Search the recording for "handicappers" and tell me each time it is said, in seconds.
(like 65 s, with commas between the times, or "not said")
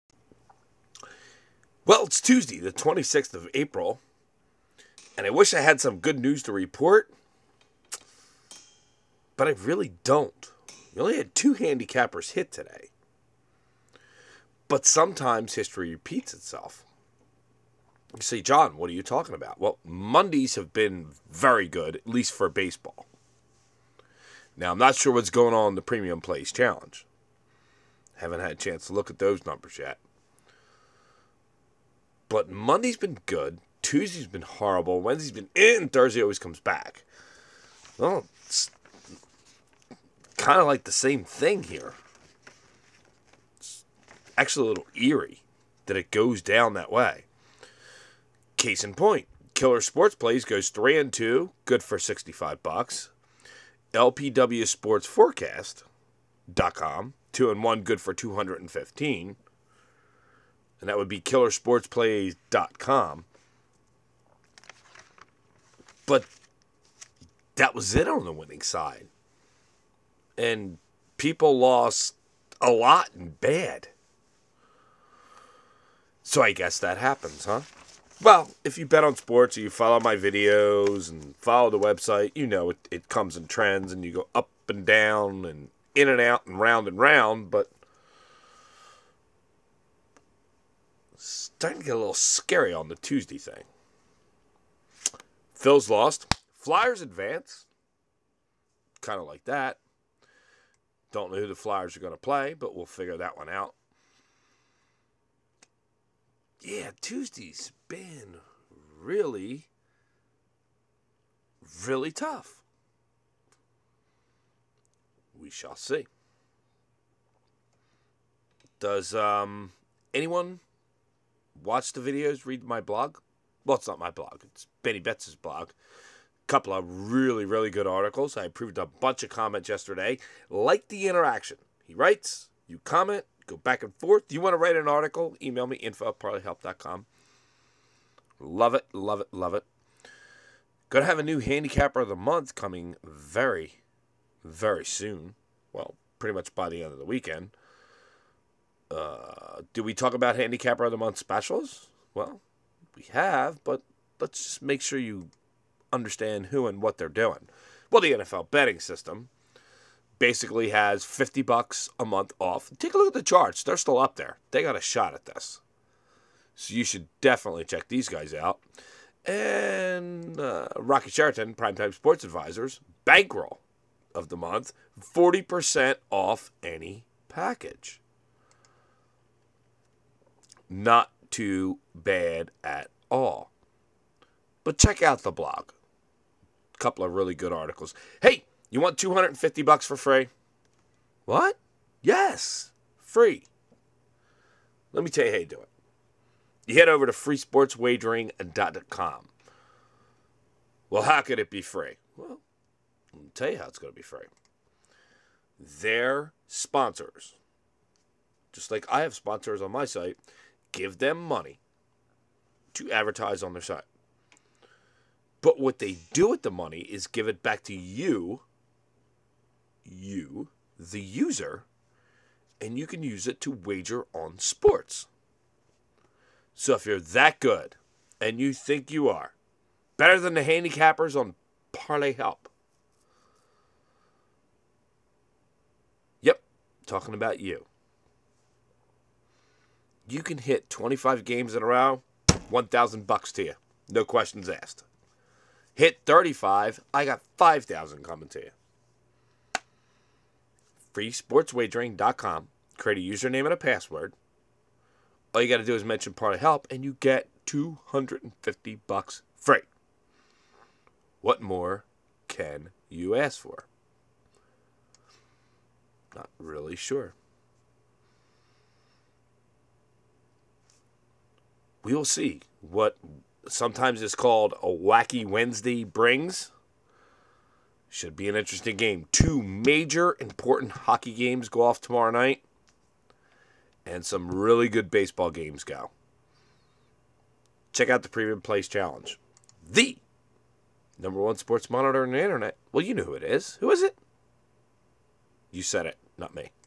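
11 s, 141 s, 150 s, 230 s.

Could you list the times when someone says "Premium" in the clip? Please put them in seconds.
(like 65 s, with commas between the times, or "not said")
25 s, 288 s.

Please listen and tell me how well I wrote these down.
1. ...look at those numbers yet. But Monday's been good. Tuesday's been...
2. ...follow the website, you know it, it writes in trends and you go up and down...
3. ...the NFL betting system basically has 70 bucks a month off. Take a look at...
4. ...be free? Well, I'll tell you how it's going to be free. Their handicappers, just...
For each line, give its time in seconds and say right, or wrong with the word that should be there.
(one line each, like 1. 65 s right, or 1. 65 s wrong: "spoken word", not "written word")
1. 28 s right
2. 81 s wrong: "comes", not "writes"
3. 158 s wrong: "50", not "70"
4. 201 s wrong: "sponsors", not "handicappers".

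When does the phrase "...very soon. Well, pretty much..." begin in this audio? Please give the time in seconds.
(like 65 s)
144 s.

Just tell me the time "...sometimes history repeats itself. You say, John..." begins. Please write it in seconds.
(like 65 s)
14 s.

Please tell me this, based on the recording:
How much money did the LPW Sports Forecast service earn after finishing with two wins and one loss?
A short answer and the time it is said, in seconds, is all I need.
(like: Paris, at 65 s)
$215, at 58 s.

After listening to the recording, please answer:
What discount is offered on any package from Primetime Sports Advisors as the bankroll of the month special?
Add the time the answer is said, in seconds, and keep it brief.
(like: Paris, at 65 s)
40%, at 175 s.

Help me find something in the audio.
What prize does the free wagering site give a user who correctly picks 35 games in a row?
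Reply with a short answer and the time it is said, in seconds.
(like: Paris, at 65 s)
$5,000, at 247 s.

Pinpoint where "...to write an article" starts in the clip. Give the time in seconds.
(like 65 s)
134 s.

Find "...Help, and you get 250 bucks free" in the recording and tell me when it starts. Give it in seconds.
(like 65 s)
256 s.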